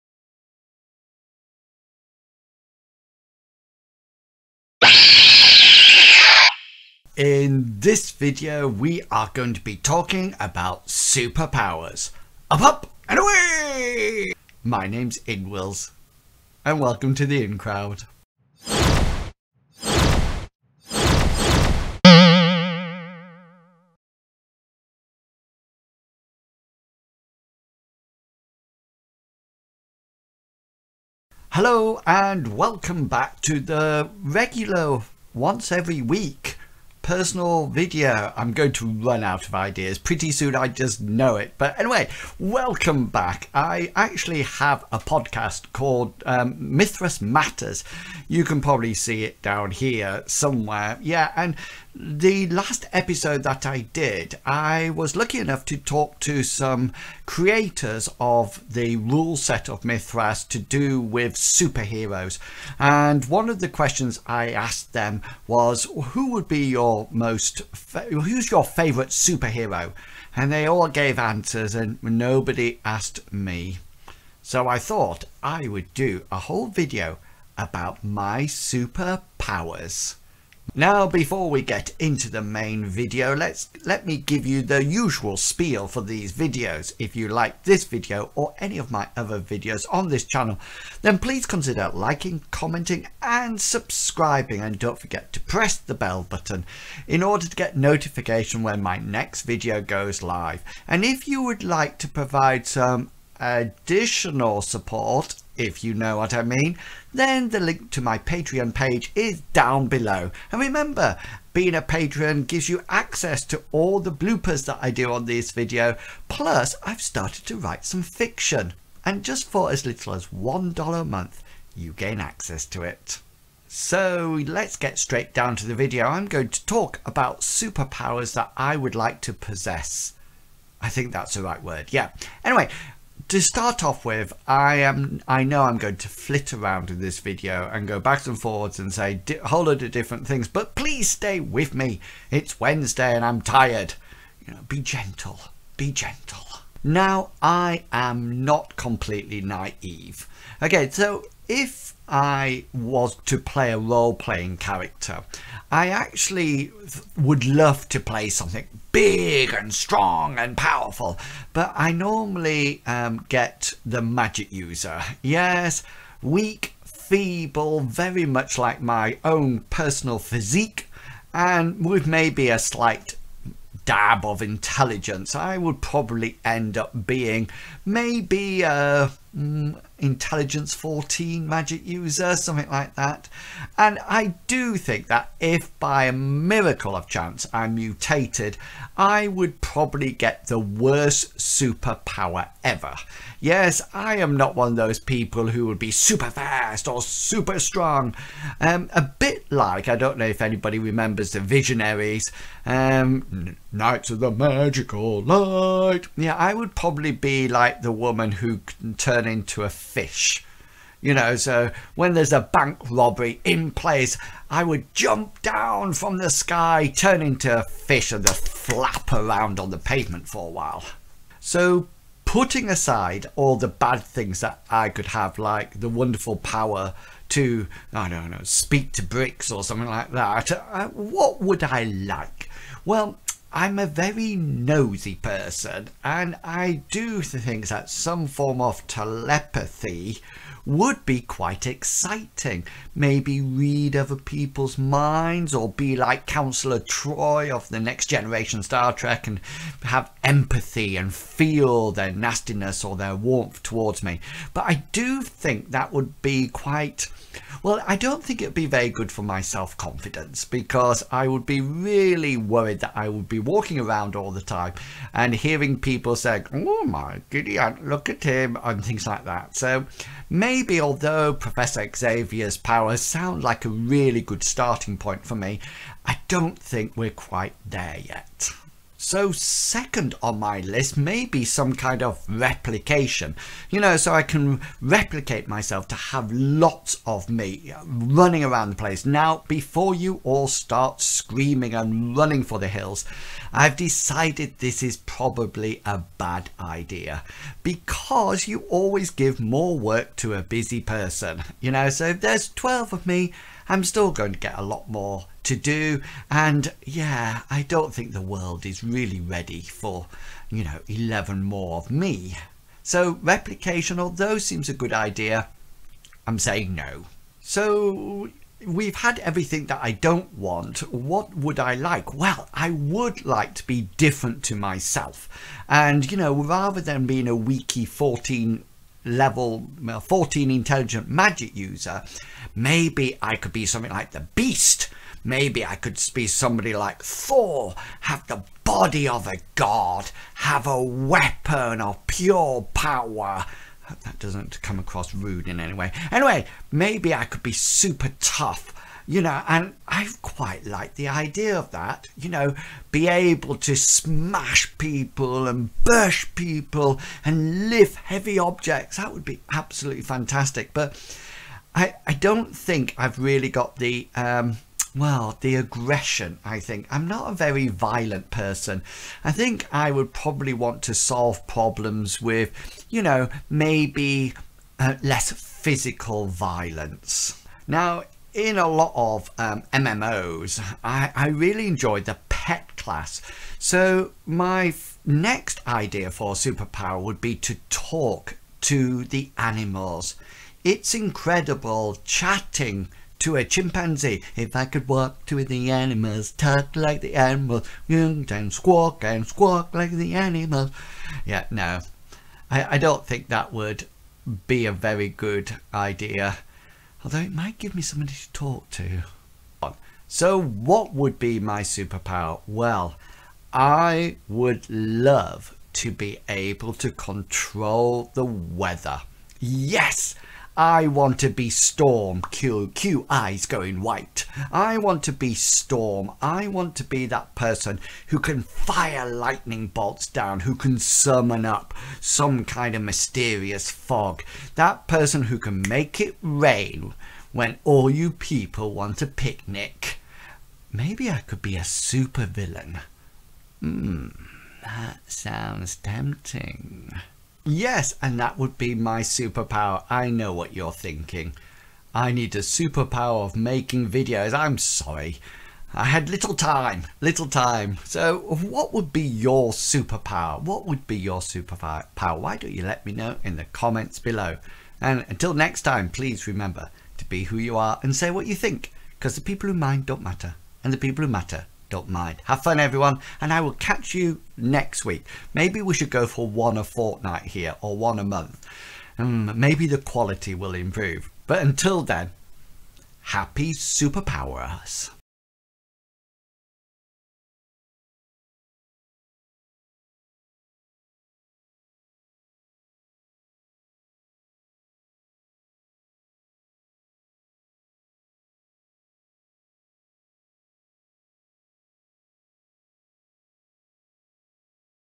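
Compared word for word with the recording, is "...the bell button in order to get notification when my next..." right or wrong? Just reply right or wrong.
right.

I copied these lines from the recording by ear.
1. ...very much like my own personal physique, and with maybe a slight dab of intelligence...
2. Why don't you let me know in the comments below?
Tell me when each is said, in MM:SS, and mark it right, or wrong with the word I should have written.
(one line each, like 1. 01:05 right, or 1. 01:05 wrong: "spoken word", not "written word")
1. 02:47 right
2. 07:42 right.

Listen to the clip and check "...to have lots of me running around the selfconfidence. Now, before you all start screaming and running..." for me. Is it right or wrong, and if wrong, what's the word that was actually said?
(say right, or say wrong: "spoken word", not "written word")
wrong: "place", not "selfconfidence".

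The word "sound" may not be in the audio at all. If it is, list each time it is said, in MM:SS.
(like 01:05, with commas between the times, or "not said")
04:33, 07:25.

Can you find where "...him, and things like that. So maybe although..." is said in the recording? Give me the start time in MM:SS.
04:28.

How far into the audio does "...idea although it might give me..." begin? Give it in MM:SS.
06:45.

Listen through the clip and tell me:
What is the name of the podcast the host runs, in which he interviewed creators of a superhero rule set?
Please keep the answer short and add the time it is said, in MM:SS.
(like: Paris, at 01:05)
Mythras Matters, at 00:46.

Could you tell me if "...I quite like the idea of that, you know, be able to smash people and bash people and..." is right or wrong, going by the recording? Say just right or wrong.
right.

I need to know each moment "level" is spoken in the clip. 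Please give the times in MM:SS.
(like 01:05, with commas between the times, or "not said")
05:29.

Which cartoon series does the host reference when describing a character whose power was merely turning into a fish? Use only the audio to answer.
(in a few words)
Visionaries.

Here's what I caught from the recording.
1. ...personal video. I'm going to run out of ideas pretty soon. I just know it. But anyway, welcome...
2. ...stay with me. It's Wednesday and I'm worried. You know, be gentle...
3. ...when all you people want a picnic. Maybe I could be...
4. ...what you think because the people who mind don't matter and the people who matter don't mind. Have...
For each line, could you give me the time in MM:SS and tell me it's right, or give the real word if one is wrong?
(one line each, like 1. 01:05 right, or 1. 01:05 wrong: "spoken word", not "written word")
1. 00:37 right
2. 02:21 wrong: "tired", not "worried"
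3. 07:17 right
4. 07:48 right.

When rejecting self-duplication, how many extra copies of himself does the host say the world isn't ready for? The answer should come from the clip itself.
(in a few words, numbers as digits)
11.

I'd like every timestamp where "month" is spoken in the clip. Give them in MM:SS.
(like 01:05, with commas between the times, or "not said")
02:01, 07:58.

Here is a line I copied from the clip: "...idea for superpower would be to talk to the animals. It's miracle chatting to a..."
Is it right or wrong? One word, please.
wrong.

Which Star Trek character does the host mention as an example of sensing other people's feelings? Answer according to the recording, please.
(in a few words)
Counselor Troi.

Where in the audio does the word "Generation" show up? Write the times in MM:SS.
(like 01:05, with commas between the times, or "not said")
04:08.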